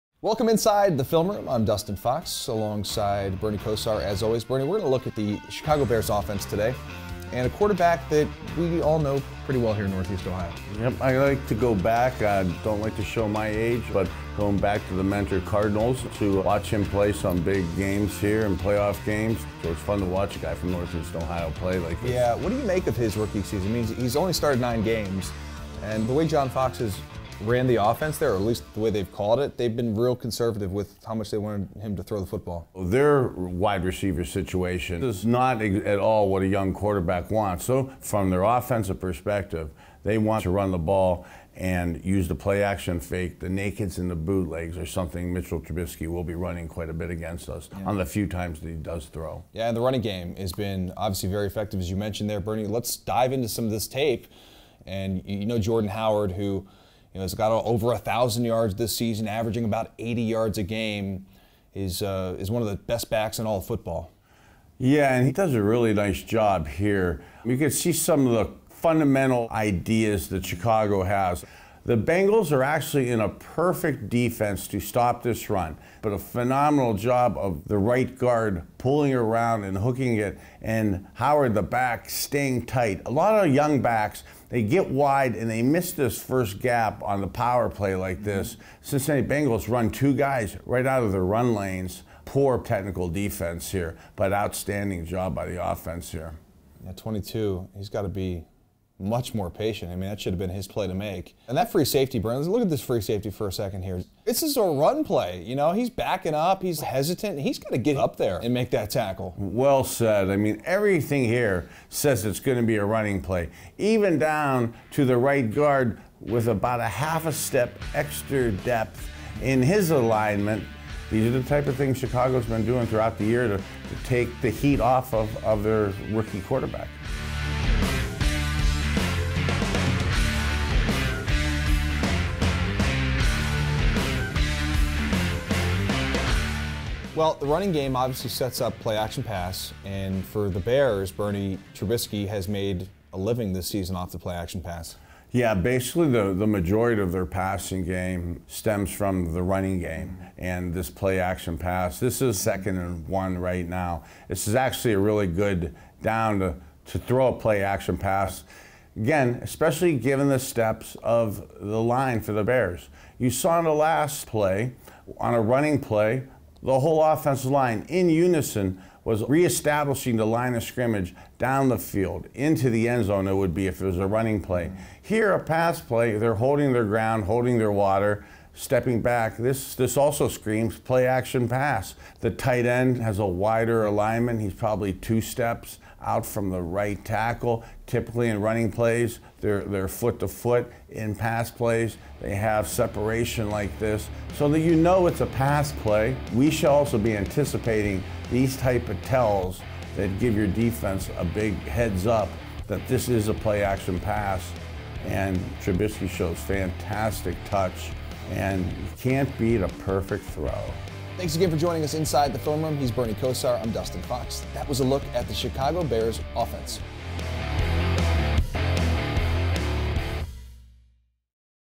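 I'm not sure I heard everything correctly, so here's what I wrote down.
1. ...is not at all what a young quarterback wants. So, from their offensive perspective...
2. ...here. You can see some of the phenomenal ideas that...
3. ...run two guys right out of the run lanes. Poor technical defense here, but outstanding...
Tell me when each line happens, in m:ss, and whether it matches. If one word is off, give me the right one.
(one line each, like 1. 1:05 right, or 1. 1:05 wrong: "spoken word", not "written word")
1. 0:35 right
2. 1:06 wrong: "fundamental", not "phenomenal"
3. 1:29 right.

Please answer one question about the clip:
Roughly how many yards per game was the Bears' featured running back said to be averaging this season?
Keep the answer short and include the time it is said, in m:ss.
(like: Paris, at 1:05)
80, at 0:59.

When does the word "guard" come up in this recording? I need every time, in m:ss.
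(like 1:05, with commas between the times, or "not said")
1:18, 1:55.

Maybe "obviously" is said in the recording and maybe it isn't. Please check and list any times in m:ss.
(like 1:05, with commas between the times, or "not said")
0:50, 2:17.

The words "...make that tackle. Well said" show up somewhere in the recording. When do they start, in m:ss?
1:48.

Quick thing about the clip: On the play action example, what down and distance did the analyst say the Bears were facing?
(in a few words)
Second and 1.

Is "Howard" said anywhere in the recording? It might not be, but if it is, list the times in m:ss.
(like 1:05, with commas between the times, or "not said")
0:55, 1:21.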